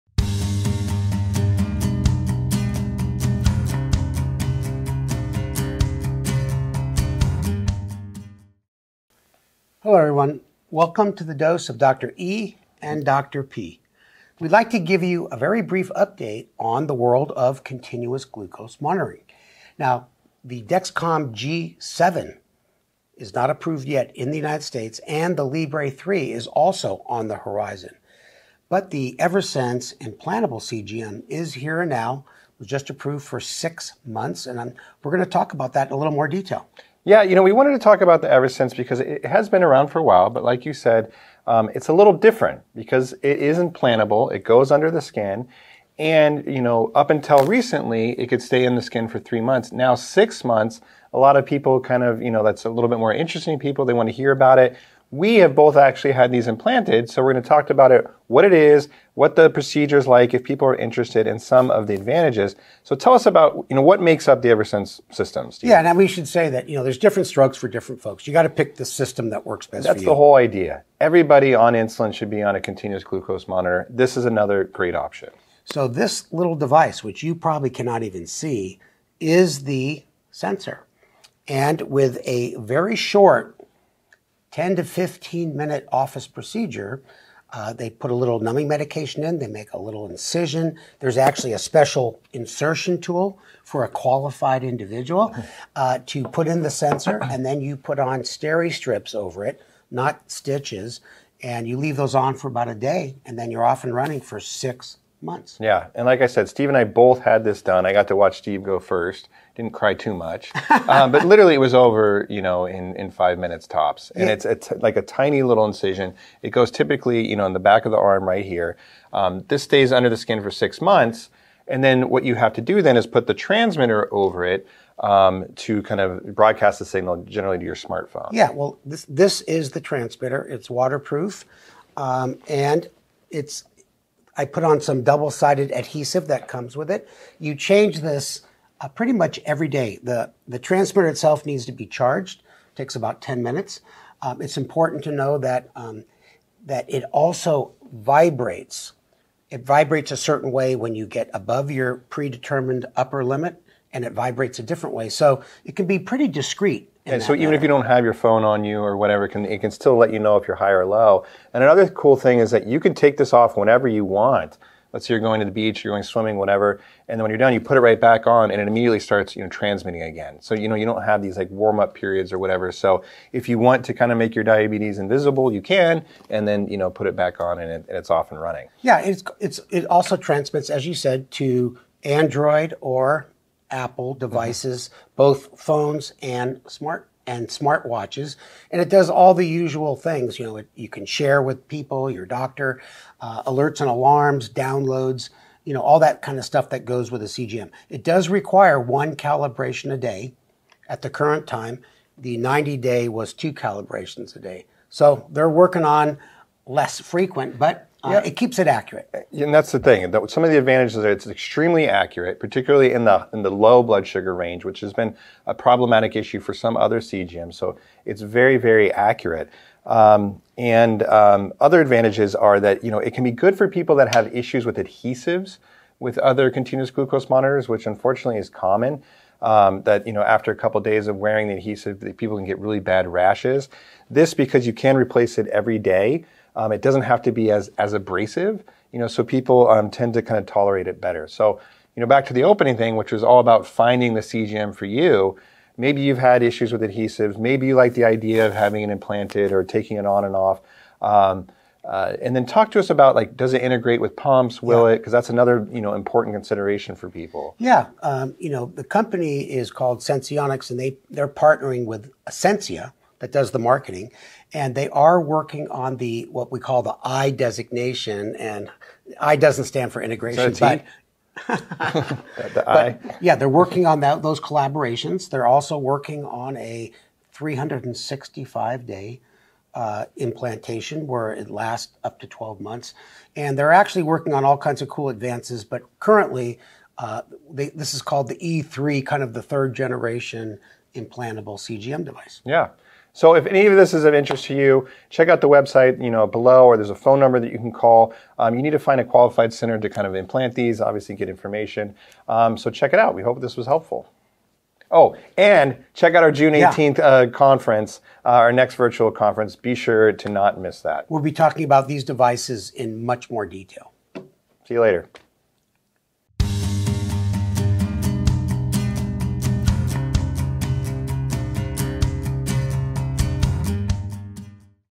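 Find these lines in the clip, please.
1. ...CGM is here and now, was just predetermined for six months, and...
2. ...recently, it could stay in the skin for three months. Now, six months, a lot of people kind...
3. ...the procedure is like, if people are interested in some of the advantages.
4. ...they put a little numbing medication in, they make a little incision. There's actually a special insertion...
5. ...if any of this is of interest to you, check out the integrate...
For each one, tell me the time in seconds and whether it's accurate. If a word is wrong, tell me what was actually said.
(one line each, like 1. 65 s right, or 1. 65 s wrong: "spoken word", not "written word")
1. 30 s wrong: "approved", not "predetermined"
2. 47 s right
3. 59 s right
4. 87 s right
5. 293 s wrong: "website", not "integrate".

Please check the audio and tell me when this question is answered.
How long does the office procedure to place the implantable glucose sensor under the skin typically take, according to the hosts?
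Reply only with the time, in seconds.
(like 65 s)
84 s.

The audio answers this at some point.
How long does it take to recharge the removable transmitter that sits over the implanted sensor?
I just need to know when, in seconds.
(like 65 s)
143 s.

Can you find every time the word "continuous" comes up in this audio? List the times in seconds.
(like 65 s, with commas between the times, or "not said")
17 s, 72 s, 226 s.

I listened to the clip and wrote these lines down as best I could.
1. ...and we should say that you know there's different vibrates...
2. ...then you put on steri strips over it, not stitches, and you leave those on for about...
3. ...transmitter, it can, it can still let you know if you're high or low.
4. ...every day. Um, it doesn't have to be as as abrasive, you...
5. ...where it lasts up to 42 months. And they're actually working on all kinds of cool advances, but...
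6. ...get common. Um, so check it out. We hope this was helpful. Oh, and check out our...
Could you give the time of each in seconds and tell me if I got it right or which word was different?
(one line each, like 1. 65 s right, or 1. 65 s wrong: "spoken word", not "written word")
1. 65 s wrong: "strokes", not "vibrates"
2. 97 s right
3. 158 s wrong: "whatever", not "transmitter"
4. 235 s right
5. 281 s wrong: "12", not "42"
6. 301 s wrong: "information", not "common".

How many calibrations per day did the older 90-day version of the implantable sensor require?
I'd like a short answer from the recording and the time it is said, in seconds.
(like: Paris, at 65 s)
2, at 203 s.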